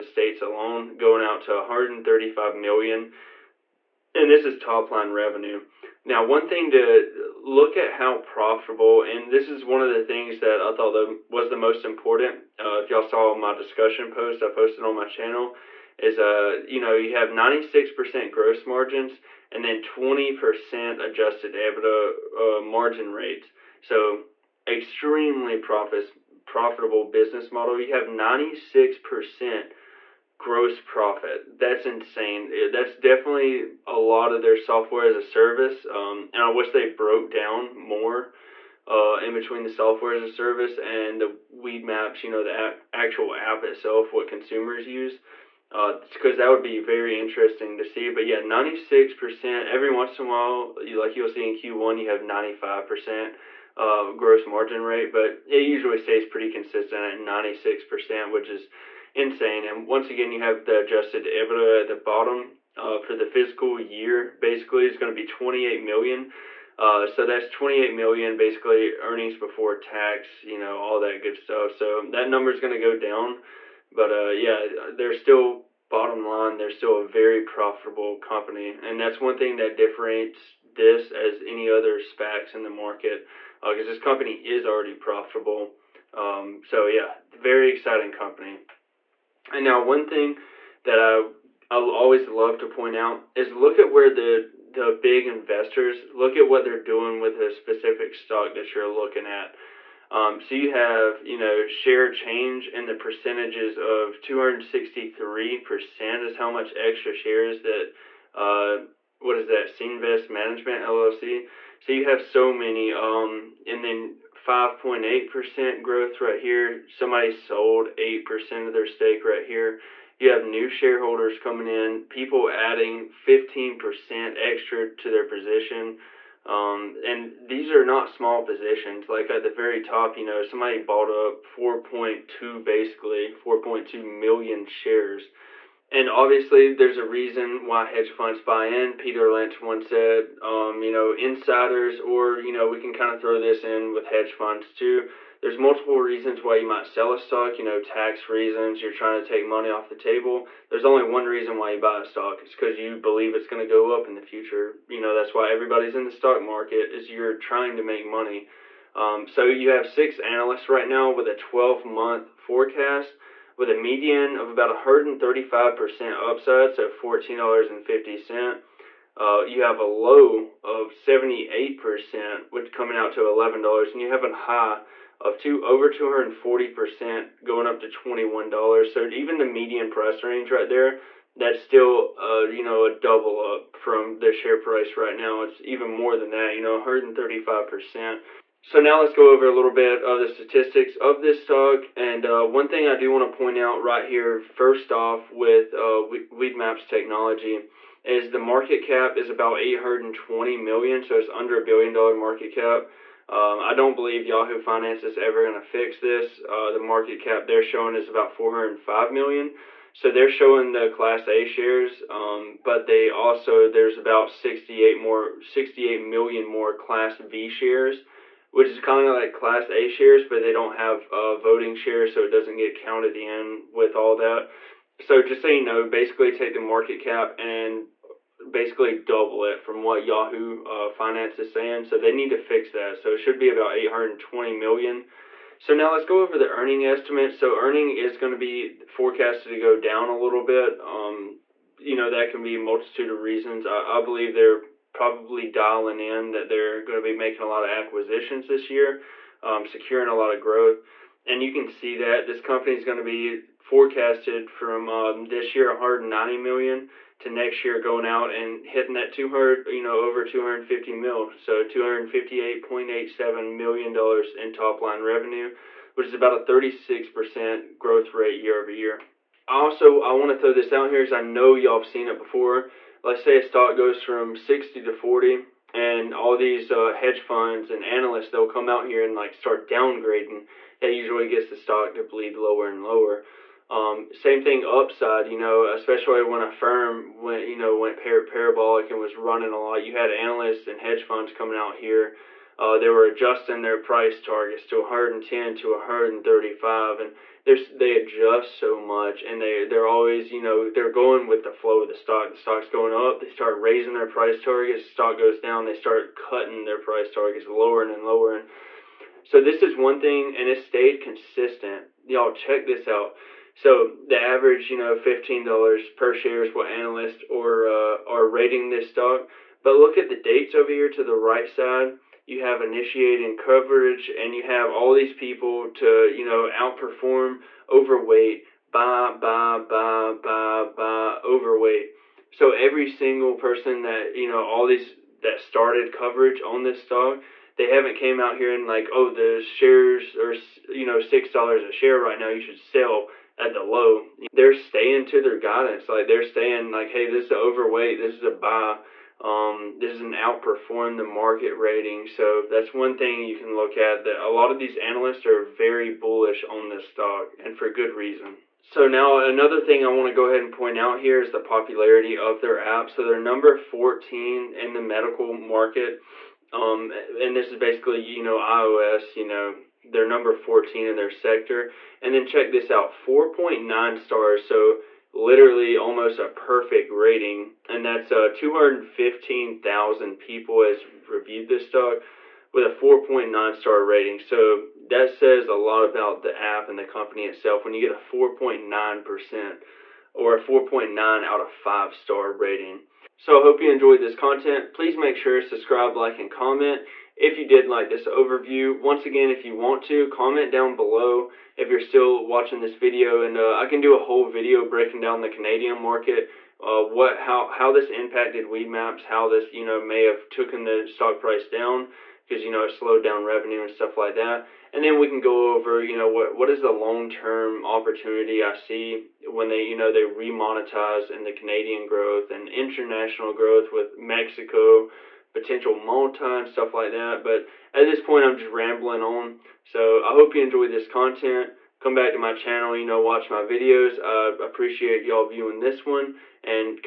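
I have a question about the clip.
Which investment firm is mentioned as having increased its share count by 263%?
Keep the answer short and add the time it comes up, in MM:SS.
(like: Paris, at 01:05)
Senvest Management LLC, at 01:49.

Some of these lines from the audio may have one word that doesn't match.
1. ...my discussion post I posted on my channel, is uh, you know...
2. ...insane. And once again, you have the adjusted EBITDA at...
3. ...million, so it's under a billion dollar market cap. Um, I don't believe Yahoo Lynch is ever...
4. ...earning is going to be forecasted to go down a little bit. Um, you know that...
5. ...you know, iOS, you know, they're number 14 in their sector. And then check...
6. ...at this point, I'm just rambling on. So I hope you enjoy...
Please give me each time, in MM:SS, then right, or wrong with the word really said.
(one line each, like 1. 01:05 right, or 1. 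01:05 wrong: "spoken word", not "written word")
1. 00:13 right
2. 00:59 right
3. 03:20 wrong: "Finance", not "Lynch"
4. 03:57 right
5. 06:08 right
6. 07:07 right.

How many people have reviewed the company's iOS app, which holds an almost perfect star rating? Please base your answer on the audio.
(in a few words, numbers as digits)
215,000.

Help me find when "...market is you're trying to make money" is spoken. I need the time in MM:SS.
02:36.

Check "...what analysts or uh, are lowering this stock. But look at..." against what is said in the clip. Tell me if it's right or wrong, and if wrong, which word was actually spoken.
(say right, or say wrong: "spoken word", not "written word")
wrong: "rating", not "lowering".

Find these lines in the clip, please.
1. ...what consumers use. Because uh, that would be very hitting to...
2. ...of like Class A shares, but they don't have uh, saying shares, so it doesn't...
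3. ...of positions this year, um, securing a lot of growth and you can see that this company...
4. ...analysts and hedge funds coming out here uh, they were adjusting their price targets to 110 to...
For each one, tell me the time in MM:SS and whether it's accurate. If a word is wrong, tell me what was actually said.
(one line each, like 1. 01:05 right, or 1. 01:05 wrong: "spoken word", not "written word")
1. 00:44 wrong: "interesting", not "hitting"
2. 03:39 wrong: "voting", not "saying"
3. 04:07 wrong: "acquisitions", not "positions"
4. 04:50 right.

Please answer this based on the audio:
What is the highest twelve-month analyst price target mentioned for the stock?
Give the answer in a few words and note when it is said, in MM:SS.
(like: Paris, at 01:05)
$21, at 02:57.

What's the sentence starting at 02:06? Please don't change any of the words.
Um, and these are not small positions.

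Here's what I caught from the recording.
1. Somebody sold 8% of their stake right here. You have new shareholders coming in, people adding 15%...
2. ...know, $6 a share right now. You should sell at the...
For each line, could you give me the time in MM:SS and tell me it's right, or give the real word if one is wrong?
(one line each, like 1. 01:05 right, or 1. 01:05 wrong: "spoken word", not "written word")
1. 01:56 right
2. 05:40 right.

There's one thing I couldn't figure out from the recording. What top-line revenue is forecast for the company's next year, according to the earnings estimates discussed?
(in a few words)
258.87 million dollars.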